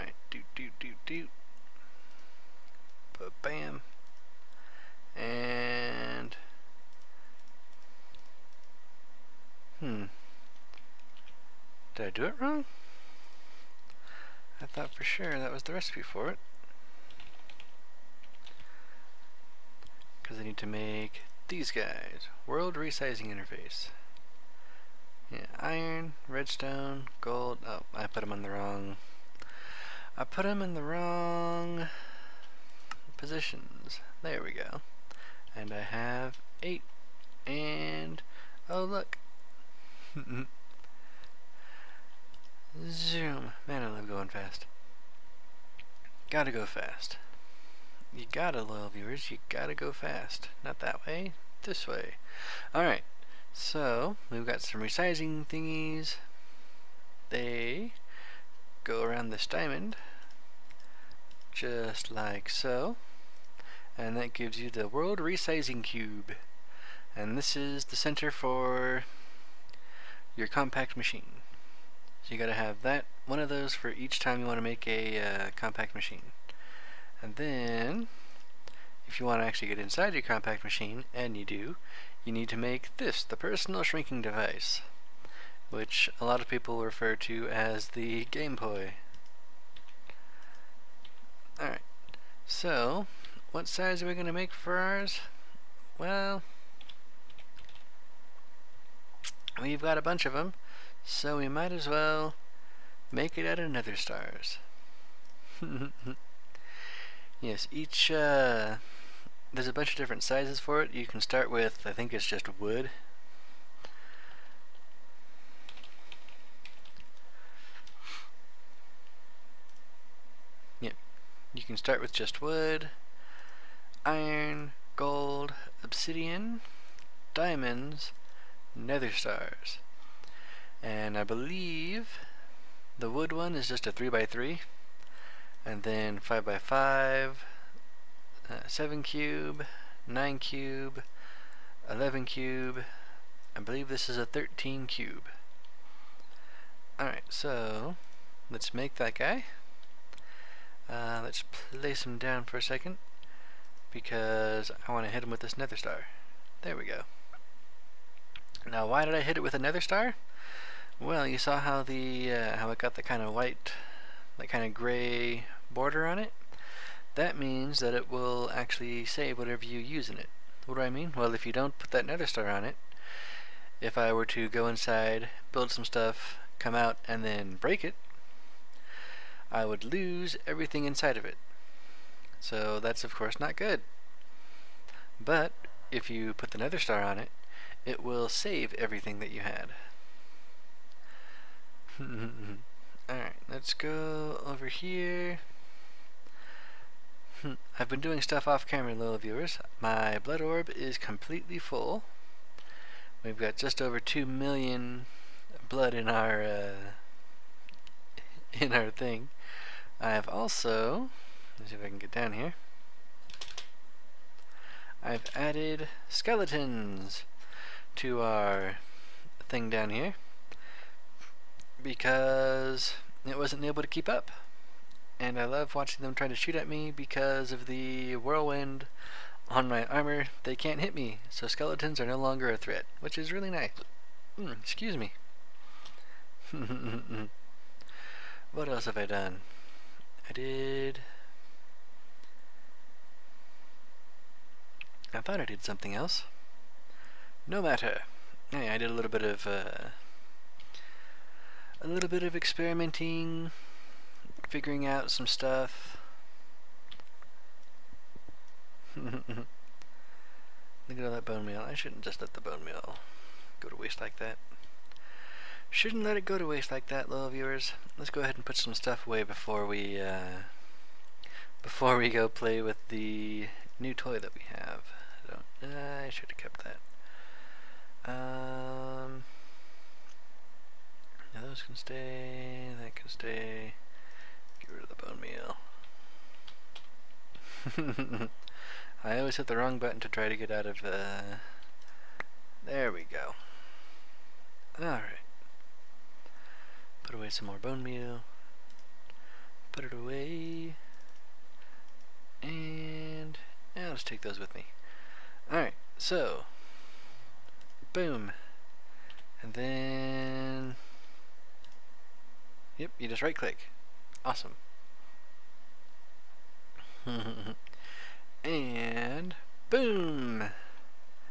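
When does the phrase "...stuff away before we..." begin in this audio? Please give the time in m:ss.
4:28.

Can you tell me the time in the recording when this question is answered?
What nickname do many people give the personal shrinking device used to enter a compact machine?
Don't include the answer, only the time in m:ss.
1:28.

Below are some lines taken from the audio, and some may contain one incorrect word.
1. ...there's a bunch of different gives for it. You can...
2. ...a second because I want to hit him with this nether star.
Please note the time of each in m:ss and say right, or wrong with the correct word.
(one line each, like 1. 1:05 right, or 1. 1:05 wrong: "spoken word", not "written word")
1. 1:49 wrong: "sizes", not "gives"
2. 2:32 right.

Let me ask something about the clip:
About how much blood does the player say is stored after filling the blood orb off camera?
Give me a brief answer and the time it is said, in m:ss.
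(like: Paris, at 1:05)
Just over 2 million, at 3:23.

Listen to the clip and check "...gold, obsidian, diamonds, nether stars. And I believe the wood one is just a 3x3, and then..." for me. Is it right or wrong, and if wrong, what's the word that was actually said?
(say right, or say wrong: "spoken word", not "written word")
right.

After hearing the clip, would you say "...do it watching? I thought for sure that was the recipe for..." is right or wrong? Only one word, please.
wrong.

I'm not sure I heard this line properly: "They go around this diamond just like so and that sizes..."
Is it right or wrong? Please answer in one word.
wrong.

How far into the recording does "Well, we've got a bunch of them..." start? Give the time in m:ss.
1:35.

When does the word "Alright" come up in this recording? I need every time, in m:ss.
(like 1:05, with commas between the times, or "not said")
0:52, 1:31, 2:26, 3:11, 4:54, 5:05.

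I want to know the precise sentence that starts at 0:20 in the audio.
Because I need to make these guys.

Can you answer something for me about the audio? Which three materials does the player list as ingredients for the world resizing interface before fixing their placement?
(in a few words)
Iron, redstone, gold.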